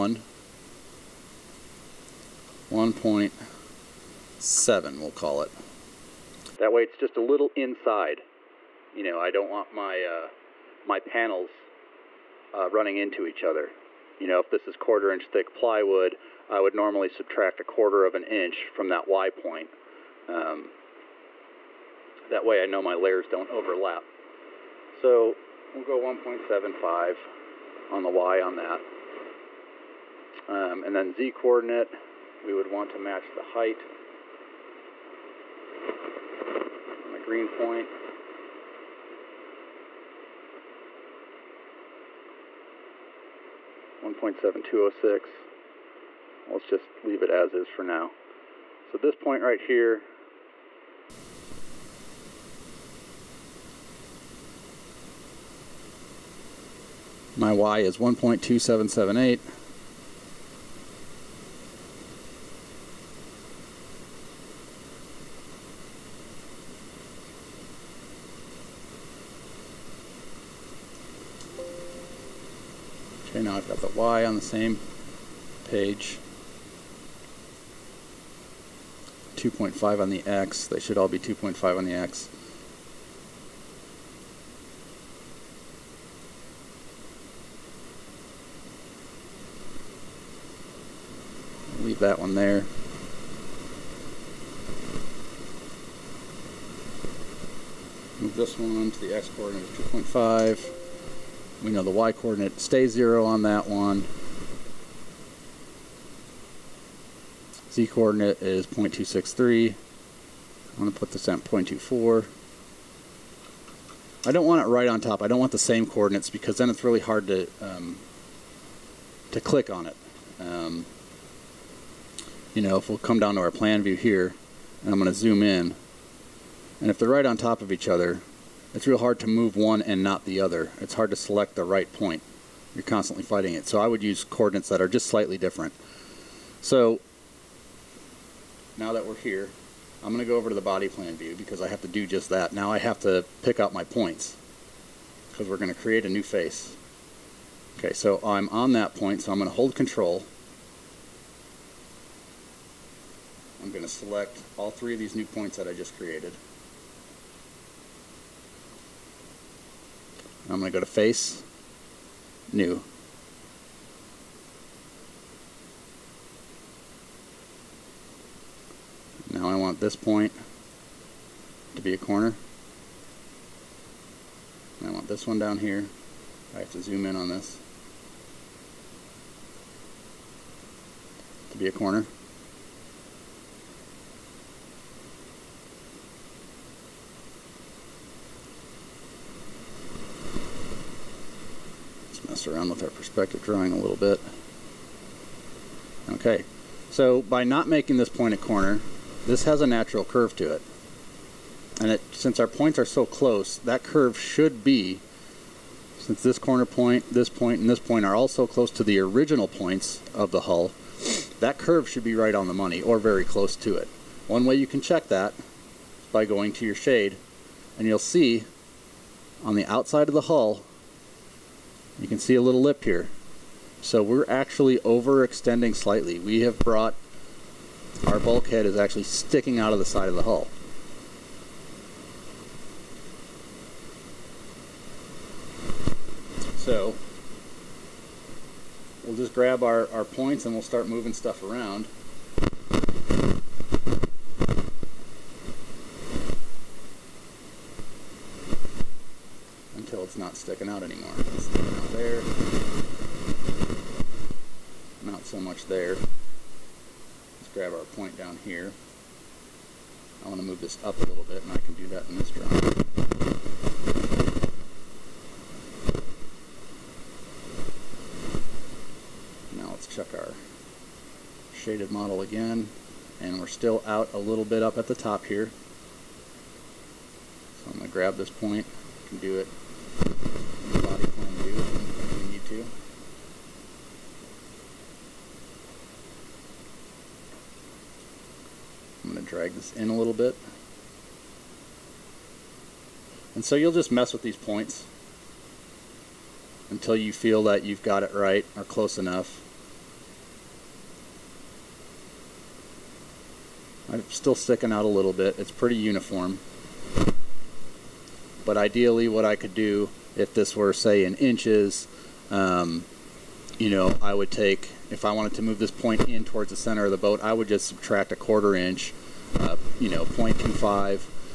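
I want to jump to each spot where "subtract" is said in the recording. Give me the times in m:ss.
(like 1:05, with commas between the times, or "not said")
0:17, 5:17.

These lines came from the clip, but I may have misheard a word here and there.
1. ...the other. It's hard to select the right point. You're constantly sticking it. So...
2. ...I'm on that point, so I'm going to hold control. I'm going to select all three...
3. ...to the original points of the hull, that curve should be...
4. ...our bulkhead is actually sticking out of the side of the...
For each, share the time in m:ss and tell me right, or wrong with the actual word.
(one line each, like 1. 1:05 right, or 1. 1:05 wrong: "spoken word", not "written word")
1. 2:10 wrong: "fighting", not "sticking"
2. 2:28 right
3. 3:28 right
4. 3:48 right.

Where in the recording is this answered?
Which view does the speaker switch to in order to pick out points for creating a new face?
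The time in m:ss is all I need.
2:20.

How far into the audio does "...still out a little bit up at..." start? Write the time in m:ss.
4:33.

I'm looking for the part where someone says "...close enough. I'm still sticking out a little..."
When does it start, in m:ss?
4:58.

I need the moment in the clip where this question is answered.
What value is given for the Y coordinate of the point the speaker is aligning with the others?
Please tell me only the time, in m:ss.
0:57.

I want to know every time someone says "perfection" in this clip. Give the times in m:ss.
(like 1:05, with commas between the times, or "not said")
not said.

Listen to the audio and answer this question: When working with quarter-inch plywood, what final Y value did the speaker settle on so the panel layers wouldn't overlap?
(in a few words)
1.75.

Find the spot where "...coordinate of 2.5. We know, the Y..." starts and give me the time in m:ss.
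1:39.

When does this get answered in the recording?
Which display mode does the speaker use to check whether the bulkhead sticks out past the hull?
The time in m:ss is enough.
3:36.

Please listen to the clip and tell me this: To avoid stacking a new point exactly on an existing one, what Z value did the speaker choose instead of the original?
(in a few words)
0.24.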